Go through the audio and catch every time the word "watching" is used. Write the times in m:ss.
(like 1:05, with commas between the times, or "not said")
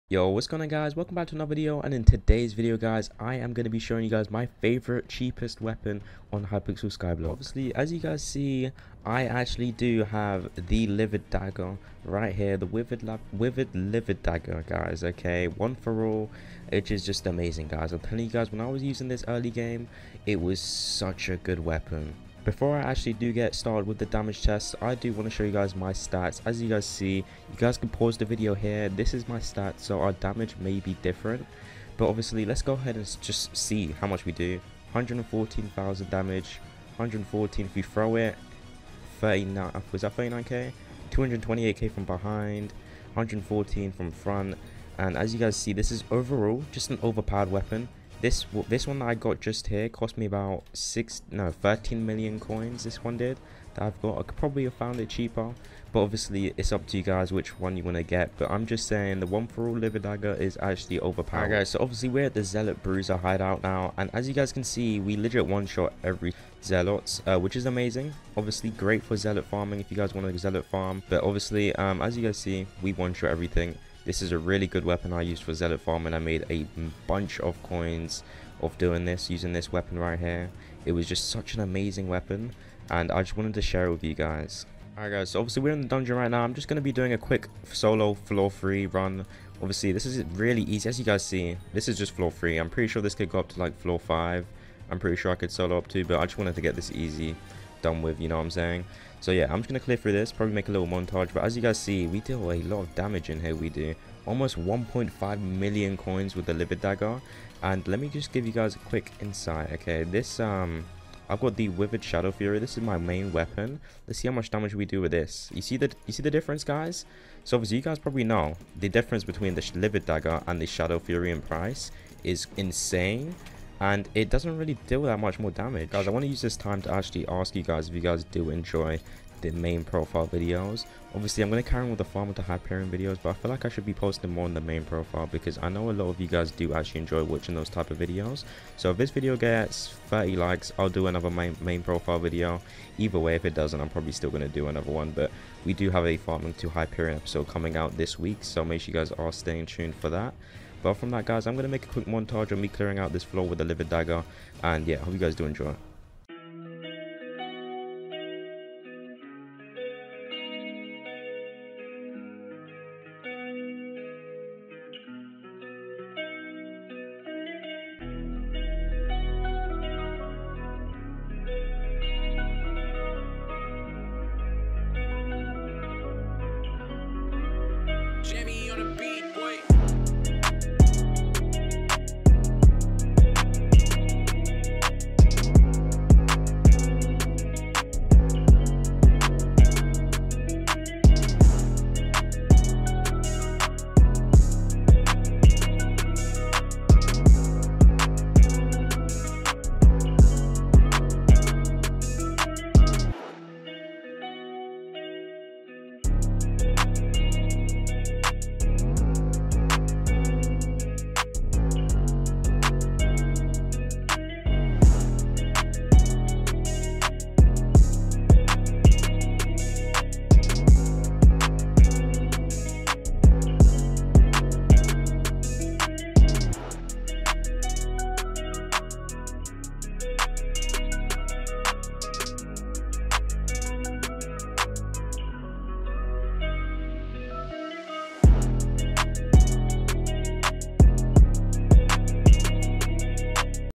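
2:17.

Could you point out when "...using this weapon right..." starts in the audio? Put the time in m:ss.
1:19.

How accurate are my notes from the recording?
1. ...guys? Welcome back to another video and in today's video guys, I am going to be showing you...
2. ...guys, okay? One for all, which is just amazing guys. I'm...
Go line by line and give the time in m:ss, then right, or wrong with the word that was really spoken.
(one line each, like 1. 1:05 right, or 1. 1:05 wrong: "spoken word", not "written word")
1. 0:00 right
2. 0:14 right.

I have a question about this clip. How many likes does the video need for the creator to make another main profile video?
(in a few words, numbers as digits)
30.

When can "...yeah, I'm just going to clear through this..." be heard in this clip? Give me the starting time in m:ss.
1:39.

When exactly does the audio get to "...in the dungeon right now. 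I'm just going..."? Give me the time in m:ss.
1:25.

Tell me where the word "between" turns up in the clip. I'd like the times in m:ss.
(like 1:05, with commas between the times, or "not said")
1:59.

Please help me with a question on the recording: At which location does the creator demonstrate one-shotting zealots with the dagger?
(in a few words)
Zealot bruiser hideout.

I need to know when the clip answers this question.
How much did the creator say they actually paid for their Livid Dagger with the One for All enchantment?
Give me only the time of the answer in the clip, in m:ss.
0:51.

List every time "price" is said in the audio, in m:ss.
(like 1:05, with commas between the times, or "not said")
2:01.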